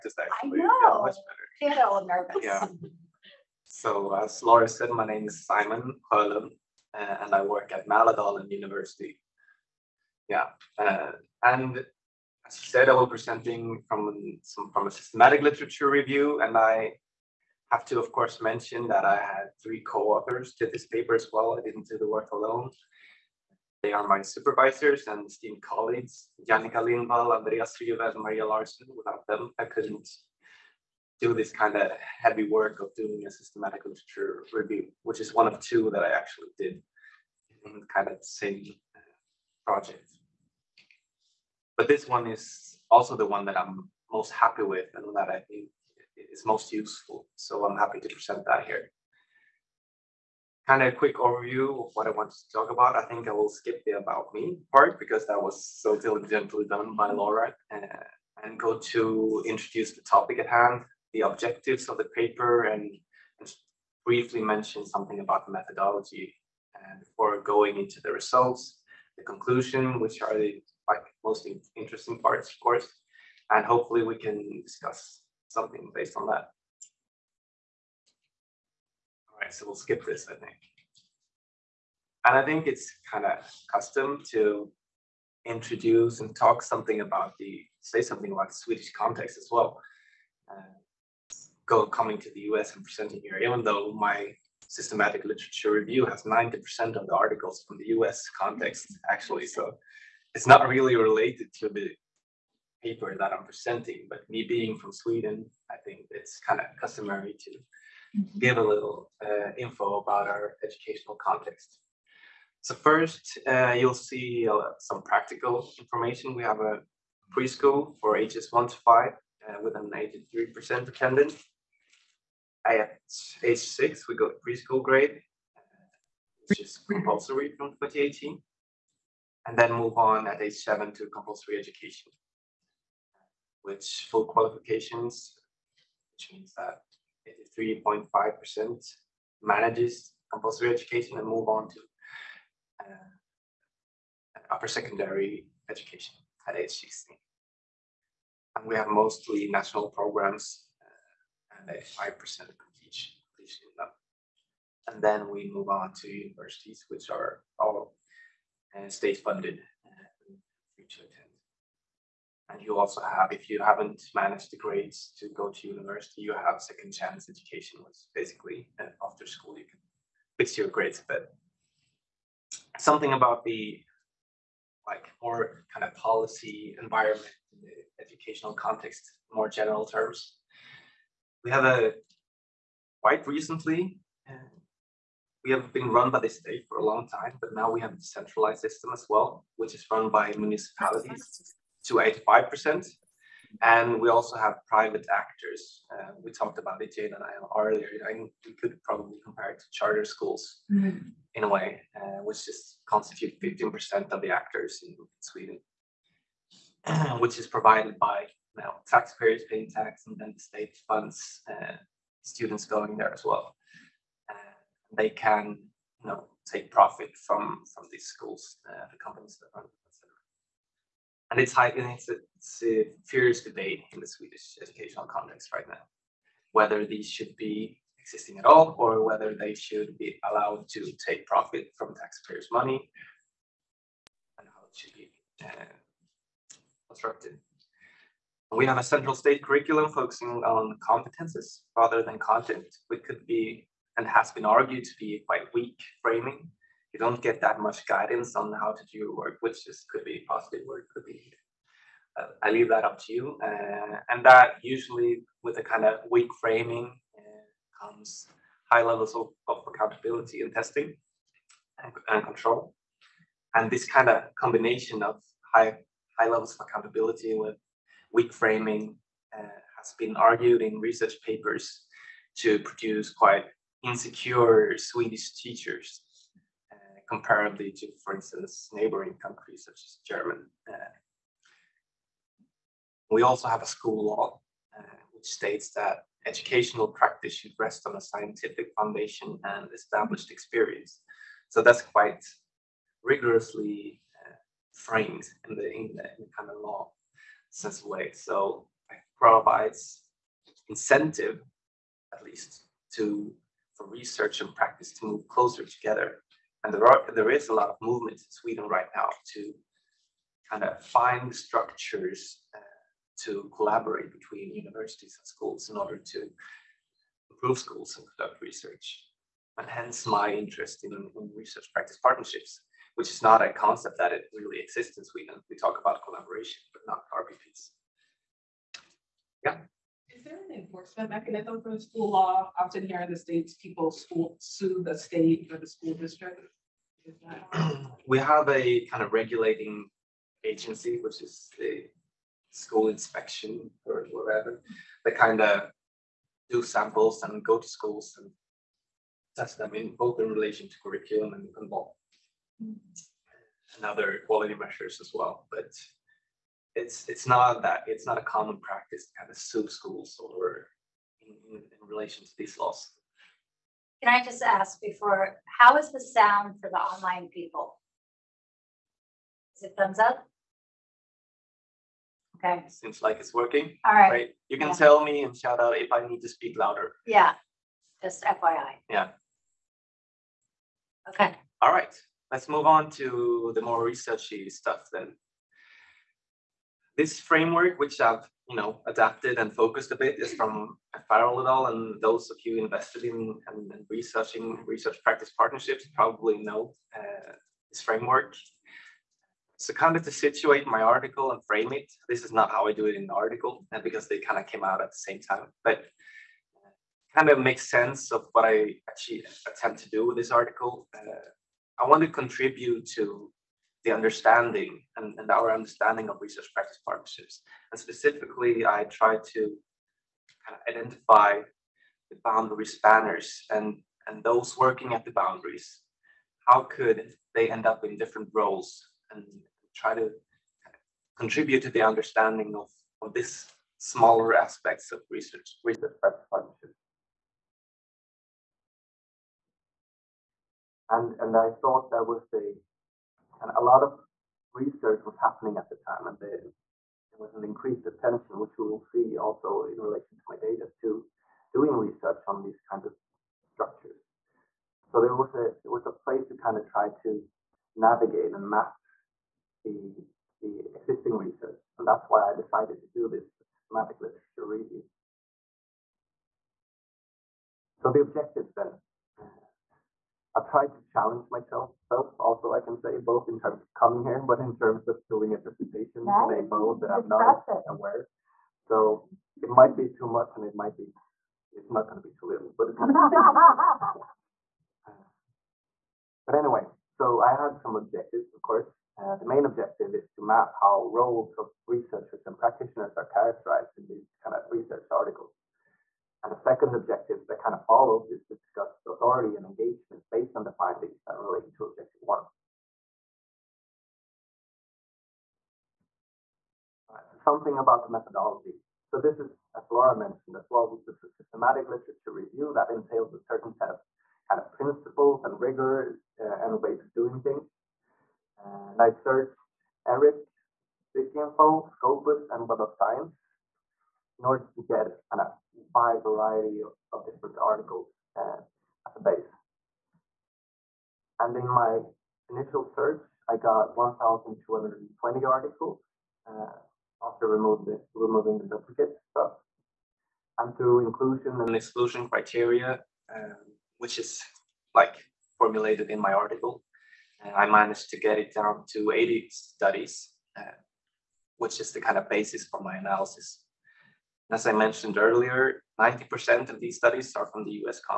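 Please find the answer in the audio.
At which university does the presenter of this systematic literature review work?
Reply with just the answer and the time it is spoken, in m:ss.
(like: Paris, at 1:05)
Mälardalen University, at 0:07.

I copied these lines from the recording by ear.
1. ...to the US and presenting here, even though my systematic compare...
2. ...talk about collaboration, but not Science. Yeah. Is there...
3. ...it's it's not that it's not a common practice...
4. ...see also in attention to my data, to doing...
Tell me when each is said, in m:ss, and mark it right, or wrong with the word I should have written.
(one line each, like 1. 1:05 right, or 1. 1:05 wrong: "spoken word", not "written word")
1. 1:32 wrong: "literature", not "compare"
2. 5:25 wrong: "RPPs", not "Science"
3. 5:56 right
4. 7:28 wrong: "relation", not "attention".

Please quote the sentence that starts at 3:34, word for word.
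Uh, they can, you know, take profit from from these schools, uh, the companies that run them, etc.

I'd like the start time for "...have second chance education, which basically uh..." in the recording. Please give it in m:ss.
2:46.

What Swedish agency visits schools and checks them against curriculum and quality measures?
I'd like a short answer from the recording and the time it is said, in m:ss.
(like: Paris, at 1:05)
school inspection, at 5:42.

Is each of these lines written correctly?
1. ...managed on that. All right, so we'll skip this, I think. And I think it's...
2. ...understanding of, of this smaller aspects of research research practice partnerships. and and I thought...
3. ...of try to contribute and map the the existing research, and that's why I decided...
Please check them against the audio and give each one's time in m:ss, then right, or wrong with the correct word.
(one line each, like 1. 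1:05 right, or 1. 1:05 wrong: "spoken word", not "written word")
1. 1:15 wrong: "based", not "managed"
2. 7:11 right
3. 7:36 wrong: "navigate", not "contribute".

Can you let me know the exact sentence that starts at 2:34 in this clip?
And then we move on to universities, which are all uh, state funded and uh, to attend.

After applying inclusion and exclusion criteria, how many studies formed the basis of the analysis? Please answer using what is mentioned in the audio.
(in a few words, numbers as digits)
80.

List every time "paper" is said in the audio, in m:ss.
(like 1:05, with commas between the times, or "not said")
0:20, 1:02, 1:42, 4:31.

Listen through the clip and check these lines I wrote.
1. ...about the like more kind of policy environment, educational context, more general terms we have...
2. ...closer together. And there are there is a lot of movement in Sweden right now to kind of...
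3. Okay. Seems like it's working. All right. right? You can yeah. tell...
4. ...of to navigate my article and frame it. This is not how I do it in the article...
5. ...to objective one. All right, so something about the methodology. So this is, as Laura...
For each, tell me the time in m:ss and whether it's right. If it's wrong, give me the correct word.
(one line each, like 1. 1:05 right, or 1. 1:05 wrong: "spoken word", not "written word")
1. 2:53 right
2. 5:05 right
3. 6:12 right
4. 6:39 wrong: "situate", not "navigate"
5. 8:21 right.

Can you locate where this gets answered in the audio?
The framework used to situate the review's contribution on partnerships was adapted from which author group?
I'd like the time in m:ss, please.
6:31.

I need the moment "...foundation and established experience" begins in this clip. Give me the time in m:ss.
4:48.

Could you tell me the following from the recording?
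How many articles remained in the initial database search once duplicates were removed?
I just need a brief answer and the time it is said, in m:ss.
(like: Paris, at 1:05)
1,220, at 8:53.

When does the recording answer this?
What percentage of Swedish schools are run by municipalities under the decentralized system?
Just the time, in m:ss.
3:12.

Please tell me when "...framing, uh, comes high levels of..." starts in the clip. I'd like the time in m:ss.
4:16.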